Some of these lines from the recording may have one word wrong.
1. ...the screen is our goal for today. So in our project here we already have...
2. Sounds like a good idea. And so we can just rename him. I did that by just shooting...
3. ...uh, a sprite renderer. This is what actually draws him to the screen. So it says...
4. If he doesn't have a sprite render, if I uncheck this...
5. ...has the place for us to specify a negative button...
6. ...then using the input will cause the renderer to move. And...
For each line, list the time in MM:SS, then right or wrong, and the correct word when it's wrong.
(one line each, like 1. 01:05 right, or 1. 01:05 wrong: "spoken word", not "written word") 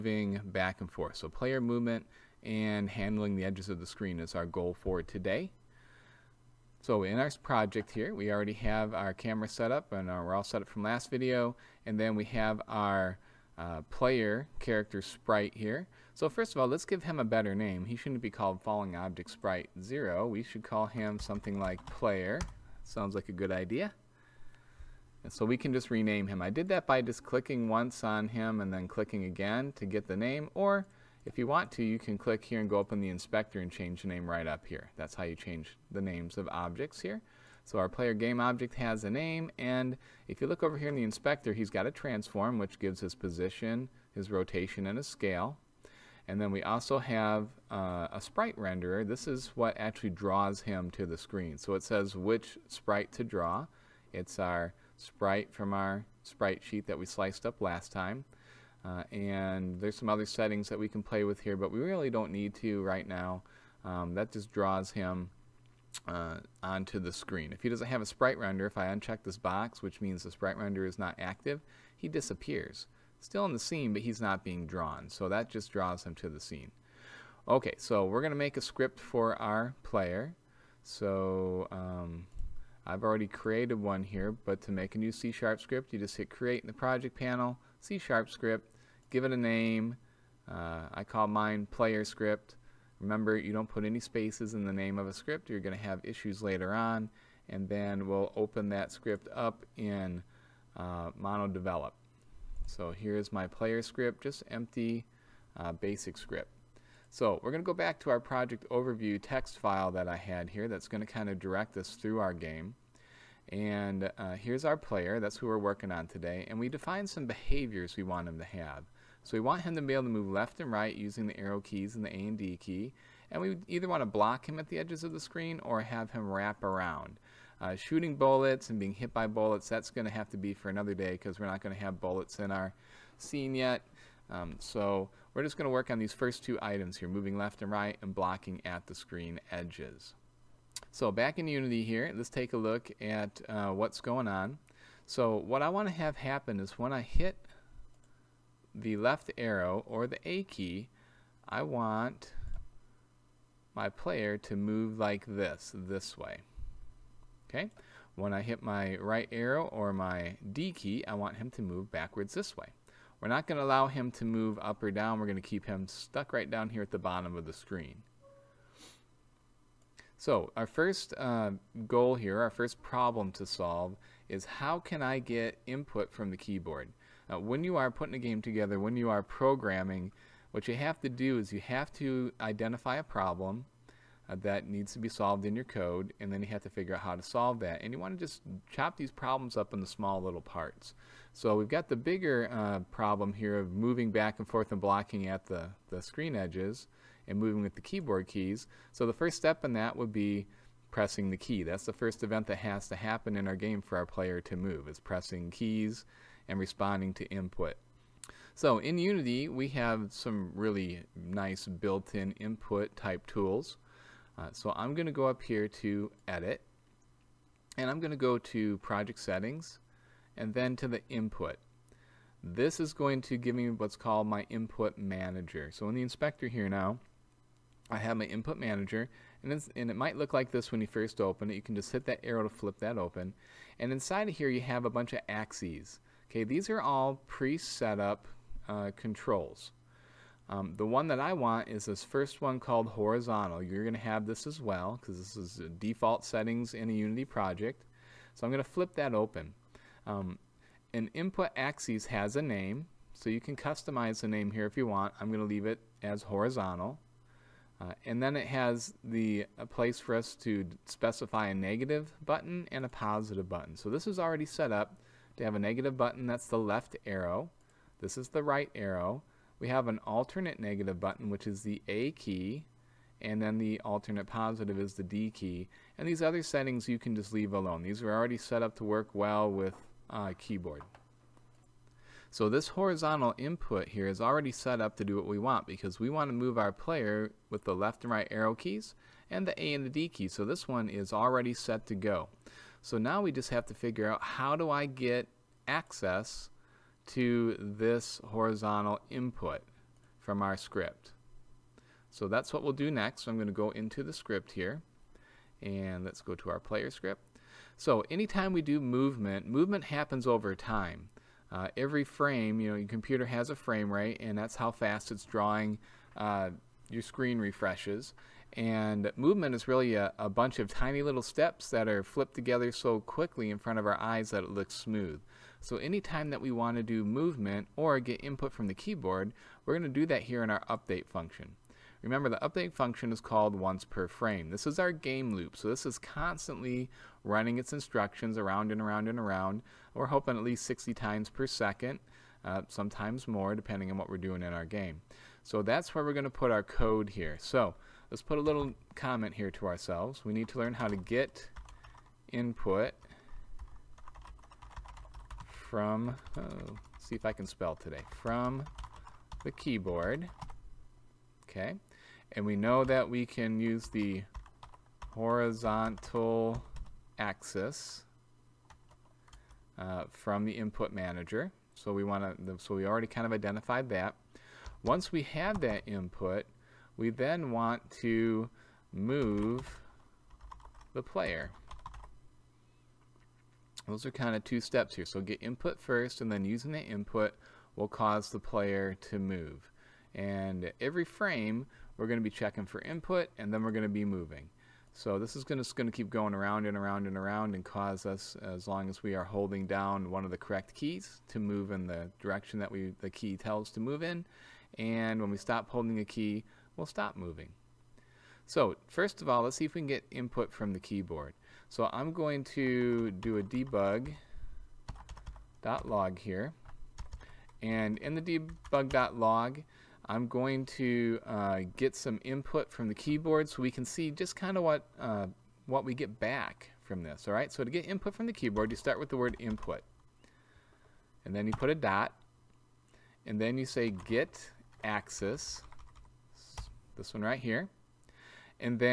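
1. 00:03 right
2. 00:22 wrong: "clicking", not "shooting"
3. 00:47 right
4. 01:07 right
5. 04:18 right
6. 06:26 wrong: "player", not "renderer".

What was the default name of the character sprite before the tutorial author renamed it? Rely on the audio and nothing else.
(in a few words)
Falling Object Sprite 0.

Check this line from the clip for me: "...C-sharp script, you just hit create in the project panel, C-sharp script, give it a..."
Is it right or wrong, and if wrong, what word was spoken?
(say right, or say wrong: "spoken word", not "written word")
right.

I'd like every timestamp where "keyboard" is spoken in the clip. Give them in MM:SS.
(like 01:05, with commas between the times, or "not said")
02:56, 03:17, 04:40, 05:28, 05:59, 06:50, 07:02, 07:08.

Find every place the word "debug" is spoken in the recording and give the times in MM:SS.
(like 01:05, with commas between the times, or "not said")
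06:53, 06:58.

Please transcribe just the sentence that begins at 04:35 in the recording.
And these other settings you can just leave alone.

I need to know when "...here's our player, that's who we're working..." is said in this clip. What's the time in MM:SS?
01:54.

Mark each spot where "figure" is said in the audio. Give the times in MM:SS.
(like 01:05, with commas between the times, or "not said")
03:06, 04:53.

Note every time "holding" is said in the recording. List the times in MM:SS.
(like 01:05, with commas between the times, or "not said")
06:39, 06:45.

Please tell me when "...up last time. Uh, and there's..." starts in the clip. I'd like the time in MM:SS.
00:57.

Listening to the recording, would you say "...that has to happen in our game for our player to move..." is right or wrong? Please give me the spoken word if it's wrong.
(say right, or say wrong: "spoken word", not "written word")
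right.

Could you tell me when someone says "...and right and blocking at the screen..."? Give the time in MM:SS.
02:17.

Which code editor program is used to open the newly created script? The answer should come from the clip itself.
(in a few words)
MonoDevelop.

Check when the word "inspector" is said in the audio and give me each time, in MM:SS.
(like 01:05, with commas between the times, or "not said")
00:33, 00:41, 03:46.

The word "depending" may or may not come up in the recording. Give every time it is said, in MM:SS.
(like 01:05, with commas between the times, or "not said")
05:43.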